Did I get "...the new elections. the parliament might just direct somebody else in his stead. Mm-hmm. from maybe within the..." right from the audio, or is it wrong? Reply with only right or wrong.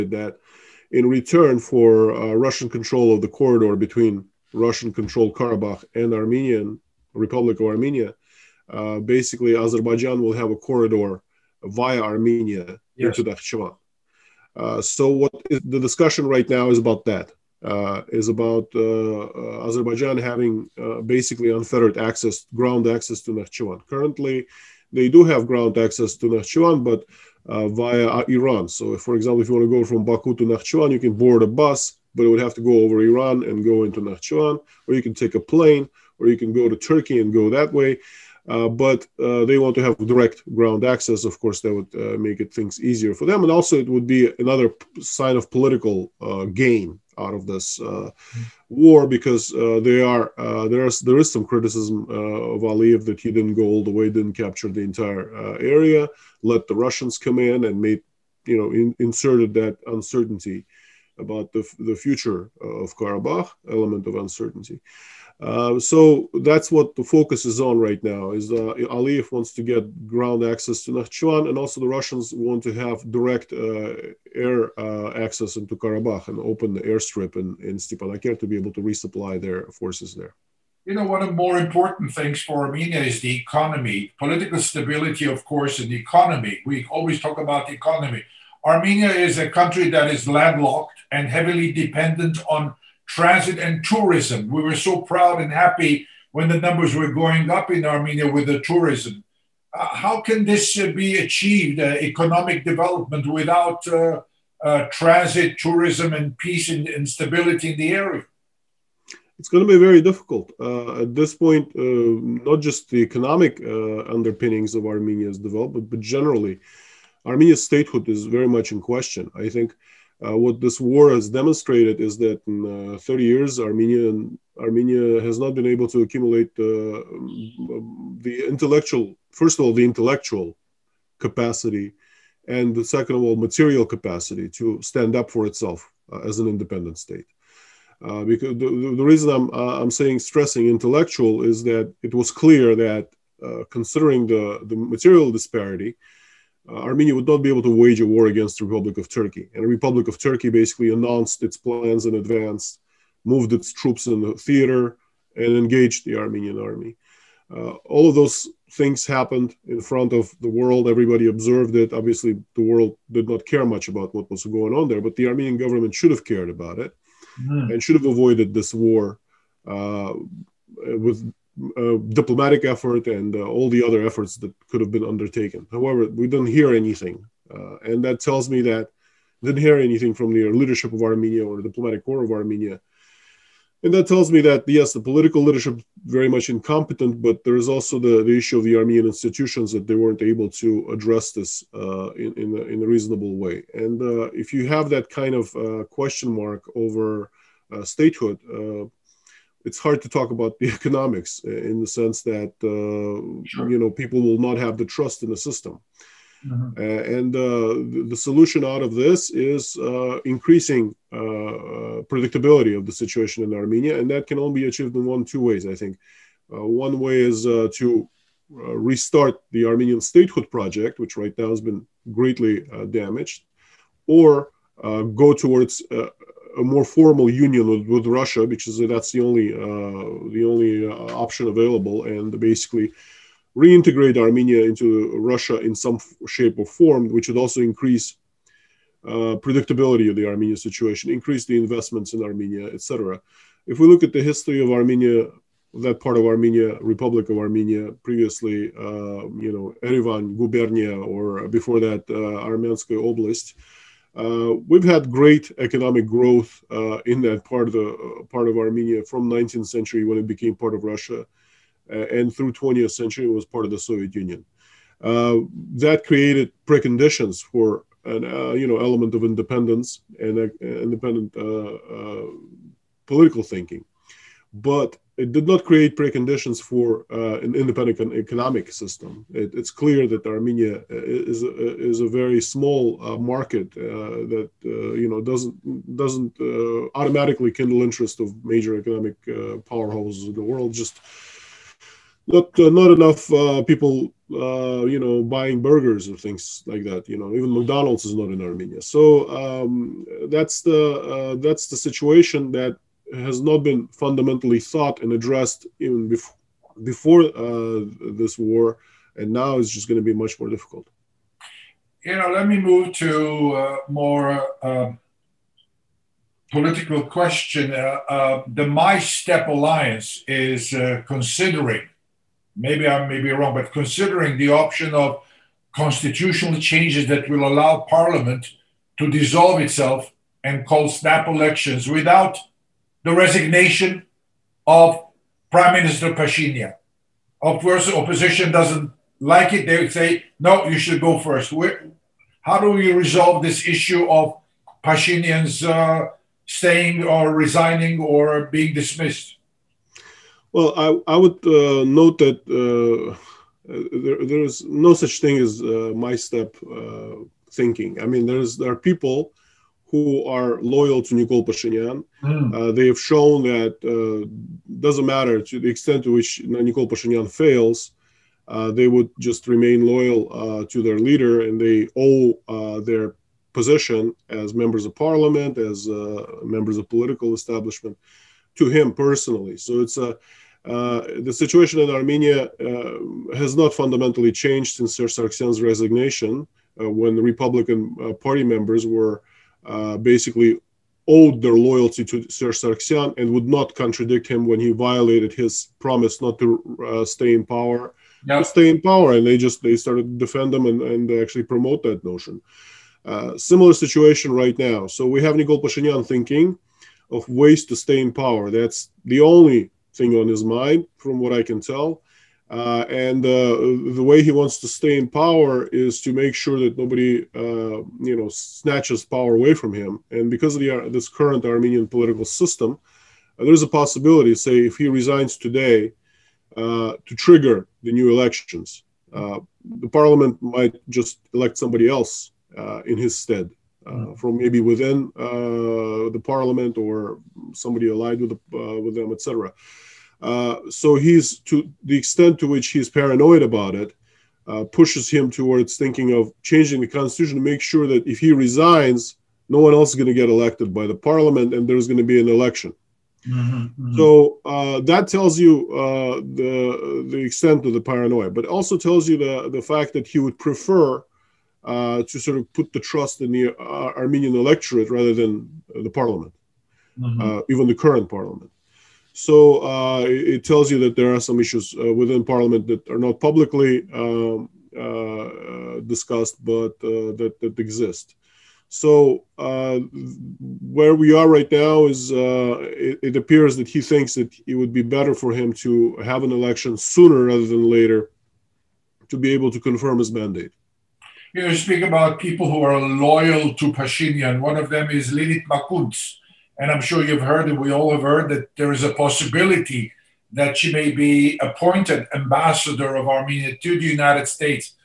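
wrong.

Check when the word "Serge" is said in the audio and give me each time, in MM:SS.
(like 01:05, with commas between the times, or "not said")
06:24, 06:32.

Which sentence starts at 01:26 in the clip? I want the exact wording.
We always talk about the economy.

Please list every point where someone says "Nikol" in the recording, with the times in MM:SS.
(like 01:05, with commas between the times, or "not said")
06:01, 06:06, 06:45.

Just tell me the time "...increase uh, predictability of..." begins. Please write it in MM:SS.
03:57.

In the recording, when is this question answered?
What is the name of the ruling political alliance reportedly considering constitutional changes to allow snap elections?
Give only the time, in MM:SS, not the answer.
05:18.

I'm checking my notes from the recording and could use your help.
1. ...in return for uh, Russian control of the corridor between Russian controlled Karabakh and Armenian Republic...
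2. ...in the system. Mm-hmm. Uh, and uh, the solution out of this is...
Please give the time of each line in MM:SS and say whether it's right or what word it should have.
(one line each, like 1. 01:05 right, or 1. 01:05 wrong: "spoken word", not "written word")
1. 00:00 right
2. 03:25 right.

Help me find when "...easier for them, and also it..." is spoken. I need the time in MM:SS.
00:42.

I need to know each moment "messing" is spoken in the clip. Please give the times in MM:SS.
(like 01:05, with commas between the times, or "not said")
not said.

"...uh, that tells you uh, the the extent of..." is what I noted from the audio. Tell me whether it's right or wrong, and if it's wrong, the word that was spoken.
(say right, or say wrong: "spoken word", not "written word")
right.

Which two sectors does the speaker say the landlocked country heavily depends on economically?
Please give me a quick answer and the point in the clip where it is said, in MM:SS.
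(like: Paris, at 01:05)
Transit and tourism, at 01:33.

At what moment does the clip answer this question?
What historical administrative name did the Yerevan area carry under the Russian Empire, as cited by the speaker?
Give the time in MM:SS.
04:09.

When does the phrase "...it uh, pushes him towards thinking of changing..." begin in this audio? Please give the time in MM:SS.
07:23.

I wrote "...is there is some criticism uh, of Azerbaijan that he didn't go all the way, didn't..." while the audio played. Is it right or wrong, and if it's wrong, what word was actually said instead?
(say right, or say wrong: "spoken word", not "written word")
wrong: "Aliyev", not "Azerbaijan".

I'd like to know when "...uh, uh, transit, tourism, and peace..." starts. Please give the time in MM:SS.
01:43.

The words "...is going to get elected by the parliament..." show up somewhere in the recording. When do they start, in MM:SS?
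07:29.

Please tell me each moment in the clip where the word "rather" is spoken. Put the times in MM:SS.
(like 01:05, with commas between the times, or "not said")
07:44, 08:07.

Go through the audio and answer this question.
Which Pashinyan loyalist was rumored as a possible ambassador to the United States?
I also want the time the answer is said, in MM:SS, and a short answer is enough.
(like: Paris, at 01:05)
Lilit Makunts, at 08:15.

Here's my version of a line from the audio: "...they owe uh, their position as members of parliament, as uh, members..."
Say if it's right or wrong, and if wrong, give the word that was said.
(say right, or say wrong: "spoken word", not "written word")
right.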